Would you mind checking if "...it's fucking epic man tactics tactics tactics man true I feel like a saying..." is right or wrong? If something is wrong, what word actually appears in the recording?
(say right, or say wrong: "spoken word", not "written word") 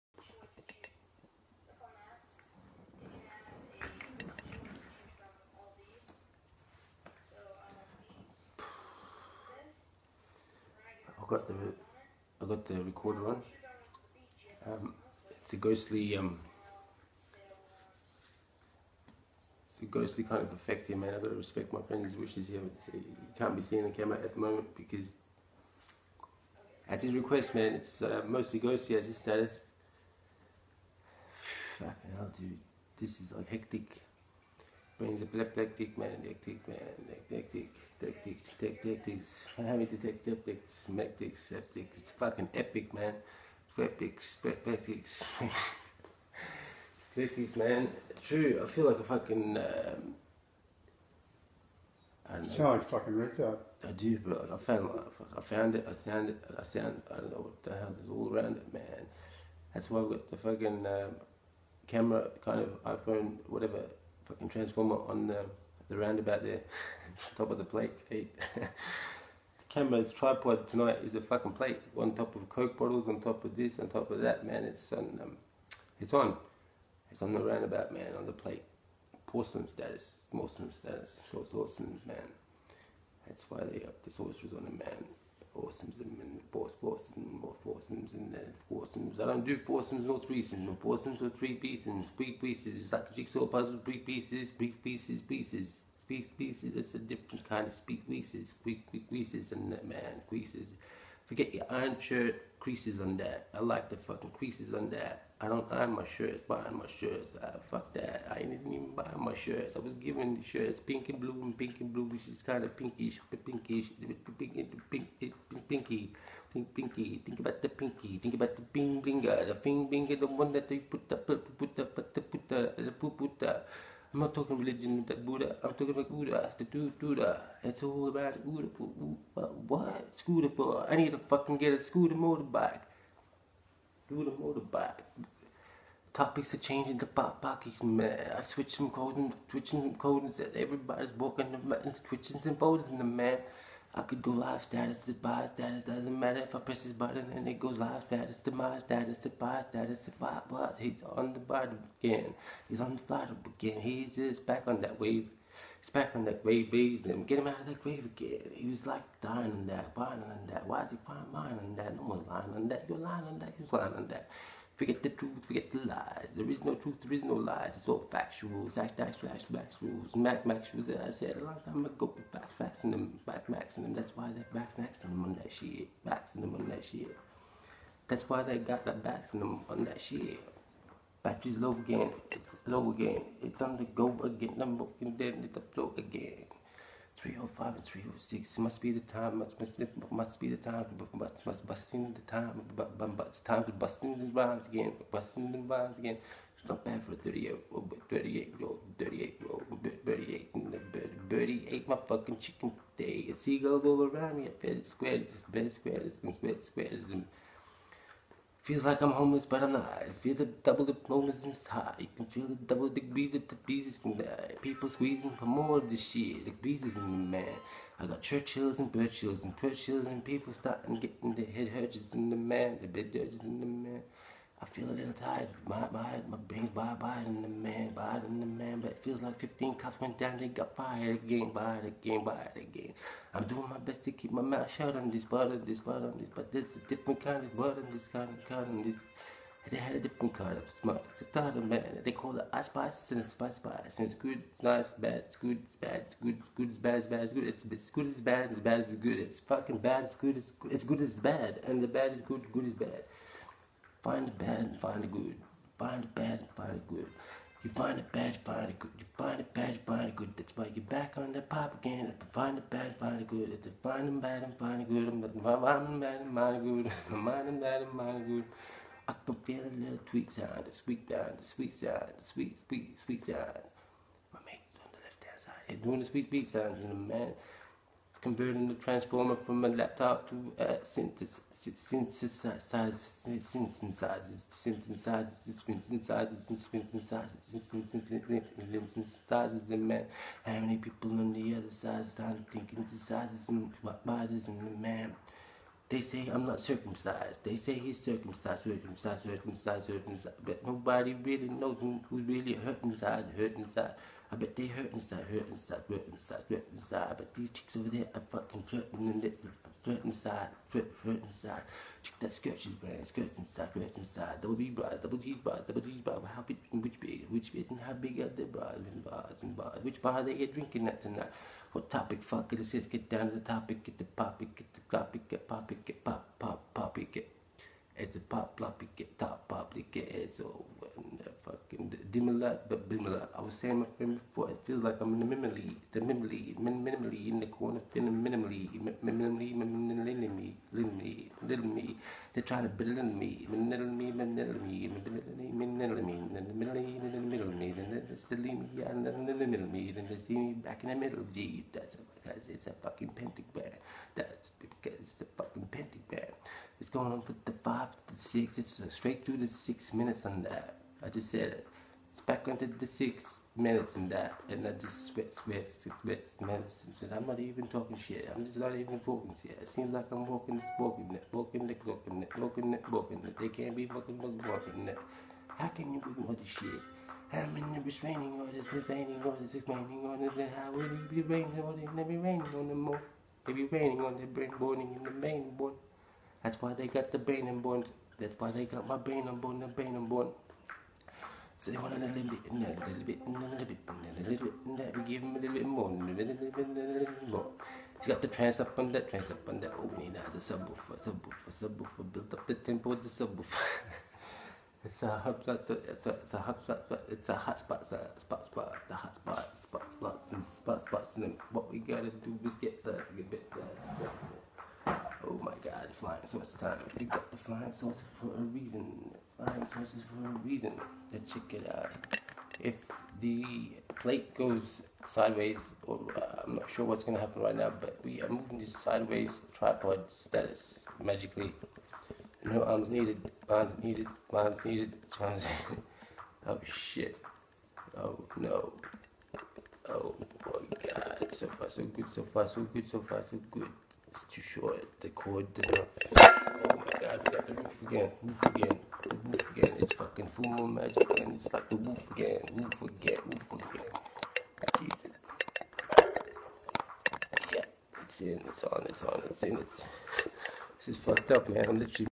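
wrong: "fucking", not "saying".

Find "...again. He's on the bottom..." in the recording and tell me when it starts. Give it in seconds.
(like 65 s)
152 s.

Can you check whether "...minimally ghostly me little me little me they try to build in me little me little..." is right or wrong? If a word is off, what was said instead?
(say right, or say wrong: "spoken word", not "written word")
wrong: "minimally", not "ghostly".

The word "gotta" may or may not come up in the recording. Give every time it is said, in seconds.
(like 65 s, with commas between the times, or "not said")
21 s, 411 s.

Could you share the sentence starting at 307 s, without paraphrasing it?
I bet these chicks over there are fucking flirting and they flirt inside, flirt, flirt inside.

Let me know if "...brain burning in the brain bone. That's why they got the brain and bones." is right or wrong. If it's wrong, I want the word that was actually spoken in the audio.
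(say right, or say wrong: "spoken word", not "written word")
right.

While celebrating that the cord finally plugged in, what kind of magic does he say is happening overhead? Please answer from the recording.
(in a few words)
full moon magic.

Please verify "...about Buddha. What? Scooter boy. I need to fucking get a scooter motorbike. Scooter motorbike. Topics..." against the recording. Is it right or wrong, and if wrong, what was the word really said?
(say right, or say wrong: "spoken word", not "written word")
right.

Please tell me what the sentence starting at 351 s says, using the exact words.
Gee, that's because it's a fucking pentagram.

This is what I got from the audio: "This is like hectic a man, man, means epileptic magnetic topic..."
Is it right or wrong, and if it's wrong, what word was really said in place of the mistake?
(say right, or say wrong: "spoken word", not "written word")
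wrong: "magnetic", not "topic".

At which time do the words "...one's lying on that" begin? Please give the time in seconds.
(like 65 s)
162 s.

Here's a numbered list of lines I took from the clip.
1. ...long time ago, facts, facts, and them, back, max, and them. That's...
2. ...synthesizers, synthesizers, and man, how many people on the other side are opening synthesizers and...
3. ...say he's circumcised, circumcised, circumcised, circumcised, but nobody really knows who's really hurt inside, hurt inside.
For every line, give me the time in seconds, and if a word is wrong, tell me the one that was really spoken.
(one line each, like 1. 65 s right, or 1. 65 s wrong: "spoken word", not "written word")
1. 171 s right
2. 285 s wrong: "thinking", not "opening"
3. 297 s right.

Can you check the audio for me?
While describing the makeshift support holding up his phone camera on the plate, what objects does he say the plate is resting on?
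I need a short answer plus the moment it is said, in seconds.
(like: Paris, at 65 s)
coke bottles, at 72 s.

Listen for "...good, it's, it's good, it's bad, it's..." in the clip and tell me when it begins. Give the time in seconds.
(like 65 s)
247 s.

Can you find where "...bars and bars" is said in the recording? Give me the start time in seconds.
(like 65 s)
319 s.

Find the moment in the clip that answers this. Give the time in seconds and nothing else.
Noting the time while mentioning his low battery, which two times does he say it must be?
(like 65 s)
187 s.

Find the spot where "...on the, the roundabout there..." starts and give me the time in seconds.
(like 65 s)
65 s.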